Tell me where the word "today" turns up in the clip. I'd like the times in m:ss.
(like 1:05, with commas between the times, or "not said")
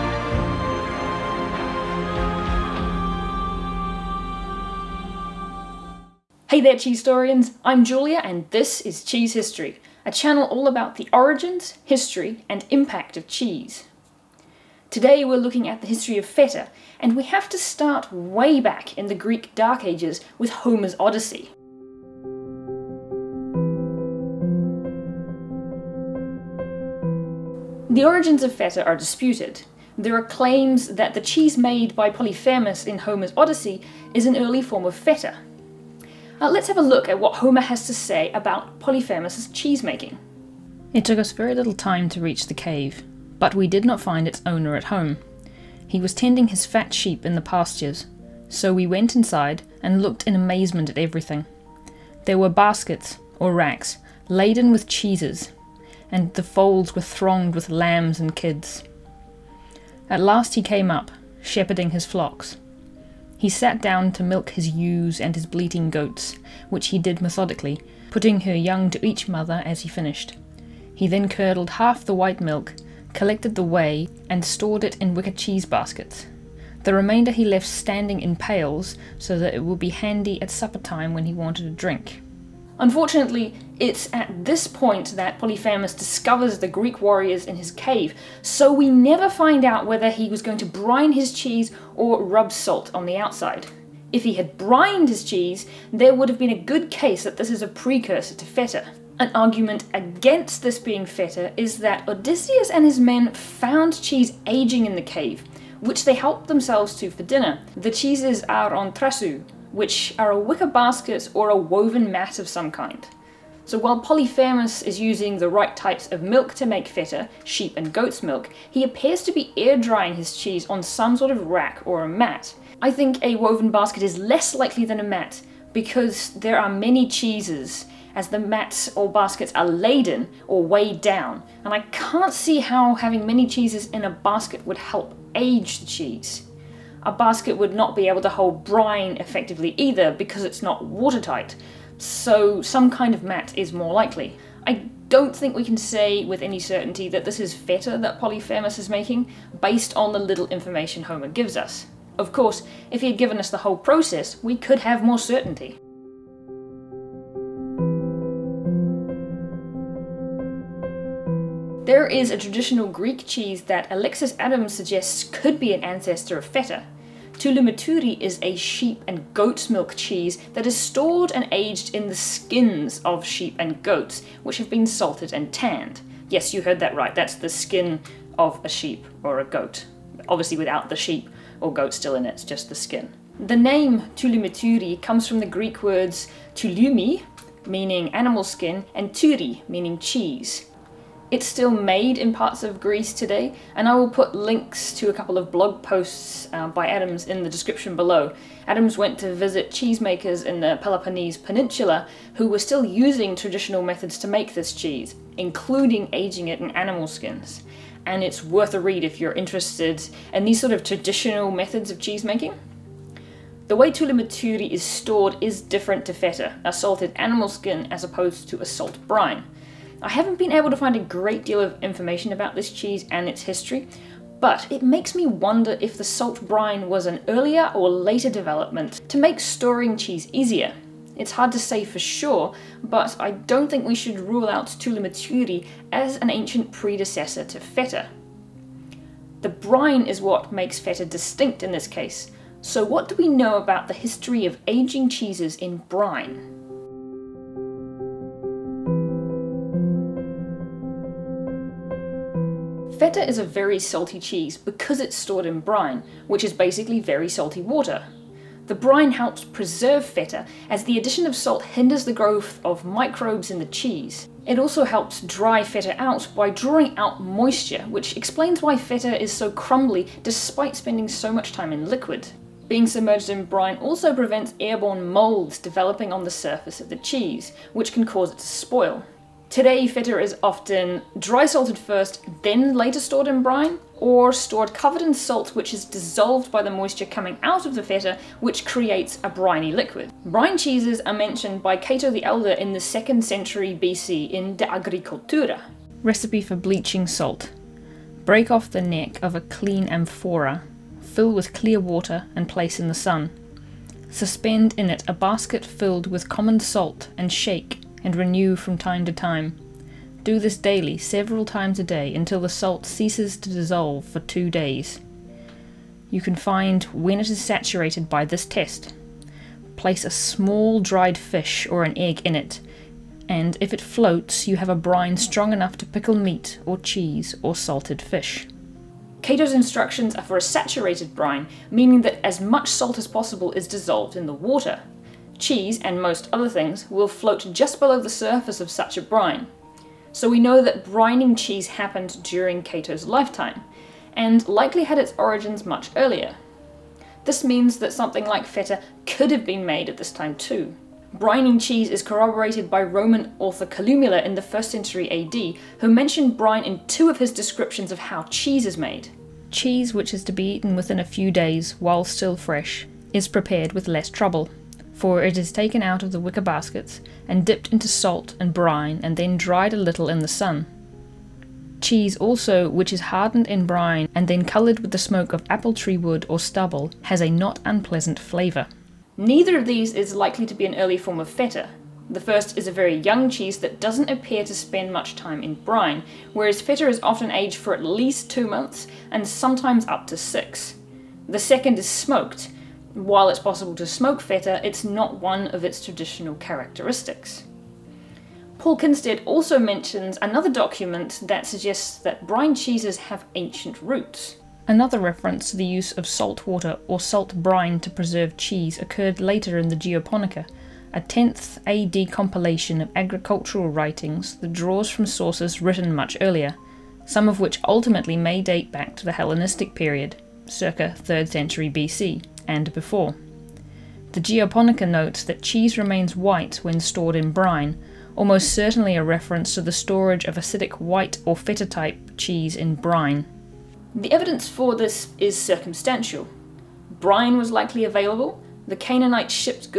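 0:14, 3:13, 4:39.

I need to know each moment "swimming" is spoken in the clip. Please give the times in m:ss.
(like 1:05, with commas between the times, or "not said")
not said.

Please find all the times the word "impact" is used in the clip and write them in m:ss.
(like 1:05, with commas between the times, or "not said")
0:12.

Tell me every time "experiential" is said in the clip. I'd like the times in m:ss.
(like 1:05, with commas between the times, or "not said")
not said.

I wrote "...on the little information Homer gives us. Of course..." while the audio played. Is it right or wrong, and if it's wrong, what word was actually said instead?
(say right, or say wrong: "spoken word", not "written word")
right.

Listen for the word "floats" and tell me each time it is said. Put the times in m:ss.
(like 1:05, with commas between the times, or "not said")
5:23, 5:37.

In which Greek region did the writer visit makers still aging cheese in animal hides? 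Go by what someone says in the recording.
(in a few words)
Peloponnese Peninsula.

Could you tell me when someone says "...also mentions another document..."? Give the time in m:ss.
6:39.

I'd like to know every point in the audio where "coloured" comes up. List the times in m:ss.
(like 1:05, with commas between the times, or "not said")
6:14.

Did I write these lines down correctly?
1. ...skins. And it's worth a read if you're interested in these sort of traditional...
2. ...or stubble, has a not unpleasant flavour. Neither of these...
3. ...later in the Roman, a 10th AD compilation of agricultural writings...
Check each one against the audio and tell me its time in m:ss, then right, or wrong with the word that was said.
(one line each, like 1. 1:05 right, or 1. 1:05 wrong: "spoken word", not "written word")
1. 3:27 right
2. 6:16 right
3. 6:49 wrong: "Geoponica", not "Roman".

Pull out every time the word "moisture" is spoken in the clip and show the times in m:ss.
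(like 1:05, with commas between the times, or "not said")
4:27, 4:46.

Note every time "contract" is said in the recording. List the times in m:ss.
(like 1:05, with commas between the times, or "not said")
not said.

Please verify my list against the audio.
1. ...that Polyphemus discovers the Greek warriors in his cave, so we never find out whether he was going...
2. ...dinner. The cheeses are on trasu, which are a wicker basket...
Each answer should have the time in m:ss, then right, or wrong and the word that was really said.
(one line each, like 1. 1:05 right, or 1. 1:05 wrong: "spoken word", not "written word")
1. 1:25 right
2. 1:47 right.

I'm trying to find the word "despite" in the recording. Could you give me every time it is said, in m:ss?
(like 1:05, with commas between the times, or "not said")
4:30.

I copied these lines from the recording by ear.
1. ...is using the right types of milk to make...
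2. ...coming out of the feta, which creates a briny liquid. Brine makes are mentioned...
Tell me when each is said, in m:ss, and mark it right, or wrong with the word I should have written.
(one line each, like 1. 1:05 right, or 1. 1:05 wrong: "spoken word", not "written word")
1. 1:54 right
2. 4:47 wrong: "cheeses", not "makes".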